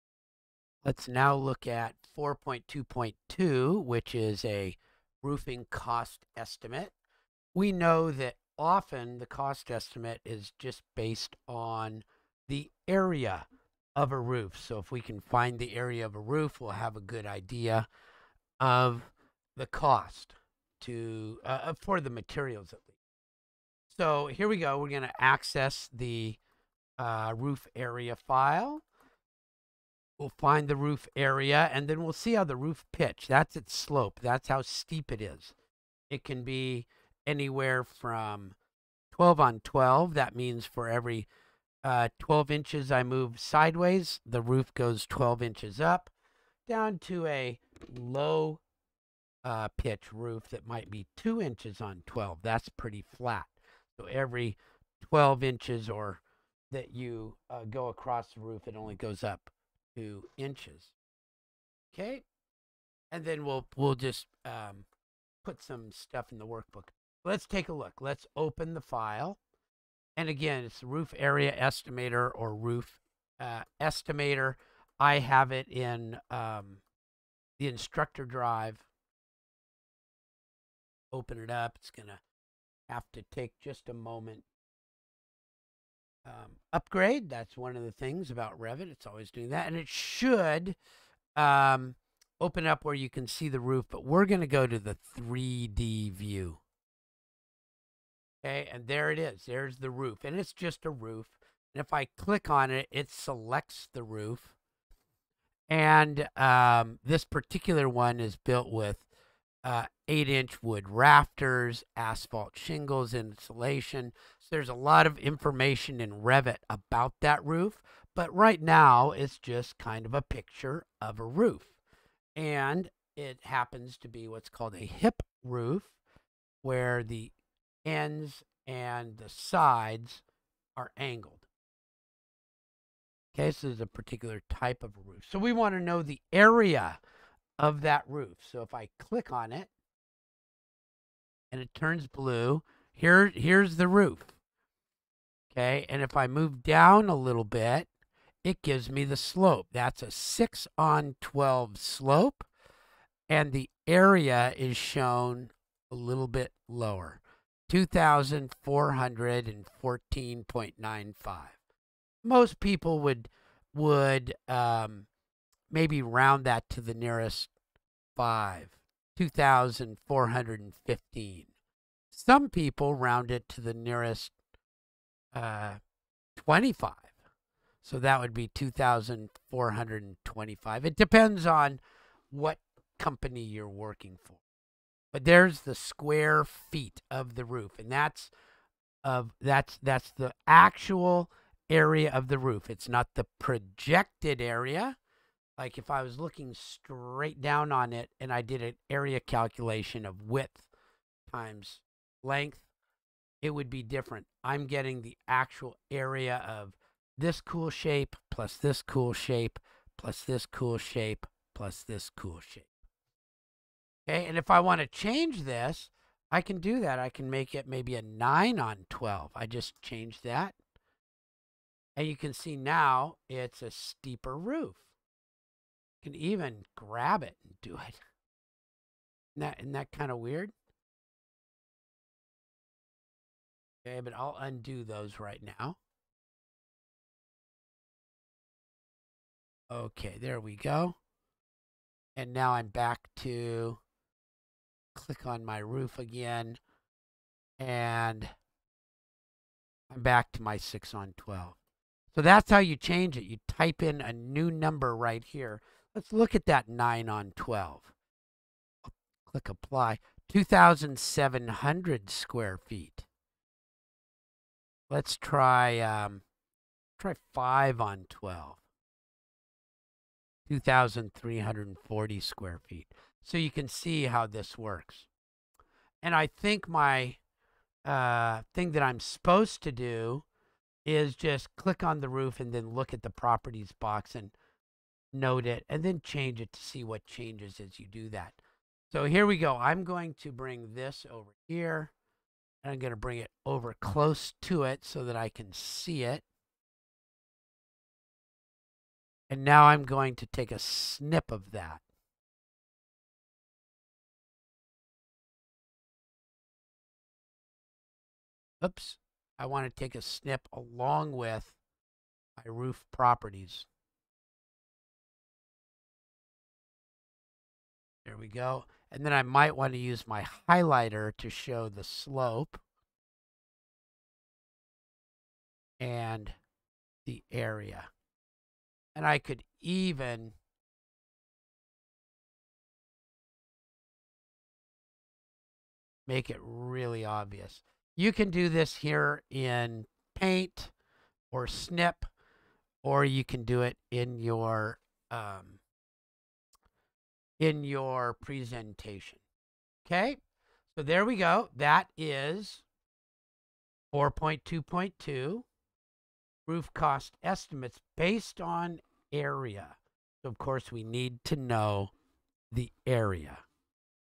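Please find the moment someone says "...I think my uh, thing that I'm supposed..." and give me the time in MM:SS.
04:36.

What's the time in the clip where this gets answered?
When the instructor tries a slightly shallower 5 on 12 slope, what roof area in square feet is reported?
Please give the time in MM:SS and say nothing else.
04:30.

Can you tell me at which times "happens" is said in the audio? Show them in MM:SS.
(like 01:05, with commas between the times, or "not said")
02:03.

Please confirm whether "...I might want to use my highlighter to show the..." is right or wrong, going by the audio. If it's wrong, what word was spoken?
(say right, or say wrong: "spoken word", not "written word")
right.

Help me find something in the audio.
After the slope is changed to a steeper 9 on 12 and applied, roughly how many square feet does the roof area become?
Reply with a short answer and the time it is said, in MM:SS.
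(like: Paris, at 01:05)
2,700, at 04:20.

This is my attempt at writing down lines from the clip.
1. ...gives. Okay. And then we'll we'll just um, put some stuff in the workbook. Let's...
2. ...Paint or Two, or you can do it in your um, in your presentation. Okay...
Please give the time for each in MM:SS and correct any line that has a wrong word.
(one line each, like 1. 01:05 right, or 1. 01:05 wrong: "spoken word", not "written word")
1. 01:00 wrong: "inches", not "gives"
2. 05:40 wrong: "Snip", not "Two".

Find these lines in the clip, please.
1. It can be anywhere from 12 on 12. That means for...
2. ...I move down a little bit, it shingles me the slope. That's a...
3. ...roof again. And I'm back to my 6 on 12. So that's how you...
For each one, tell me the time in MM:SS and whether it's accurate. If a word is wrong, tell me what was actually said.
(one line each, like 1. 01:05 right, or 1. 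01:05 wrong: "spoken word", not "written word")
1. 00:36 right
2. 02:26 wrong: "gives", not "shingles"
3. 04:05 right.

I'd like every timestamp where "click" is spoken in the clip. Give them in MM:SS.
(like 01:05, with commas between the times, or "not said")
01:42, 02:18, 04:04, 04:19, 04:41.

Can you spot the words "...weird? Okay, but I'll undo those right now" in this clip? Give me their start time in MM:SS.
03:50.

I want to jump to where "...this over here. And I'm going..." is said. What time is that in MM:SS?
04:50.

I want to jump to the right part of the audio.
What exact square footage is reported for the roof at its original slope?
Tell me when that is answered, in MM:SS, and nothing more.
02:37.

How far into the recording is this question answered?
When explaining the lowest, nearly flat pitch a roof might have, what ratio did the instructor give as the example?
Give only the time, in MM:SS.
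00:51.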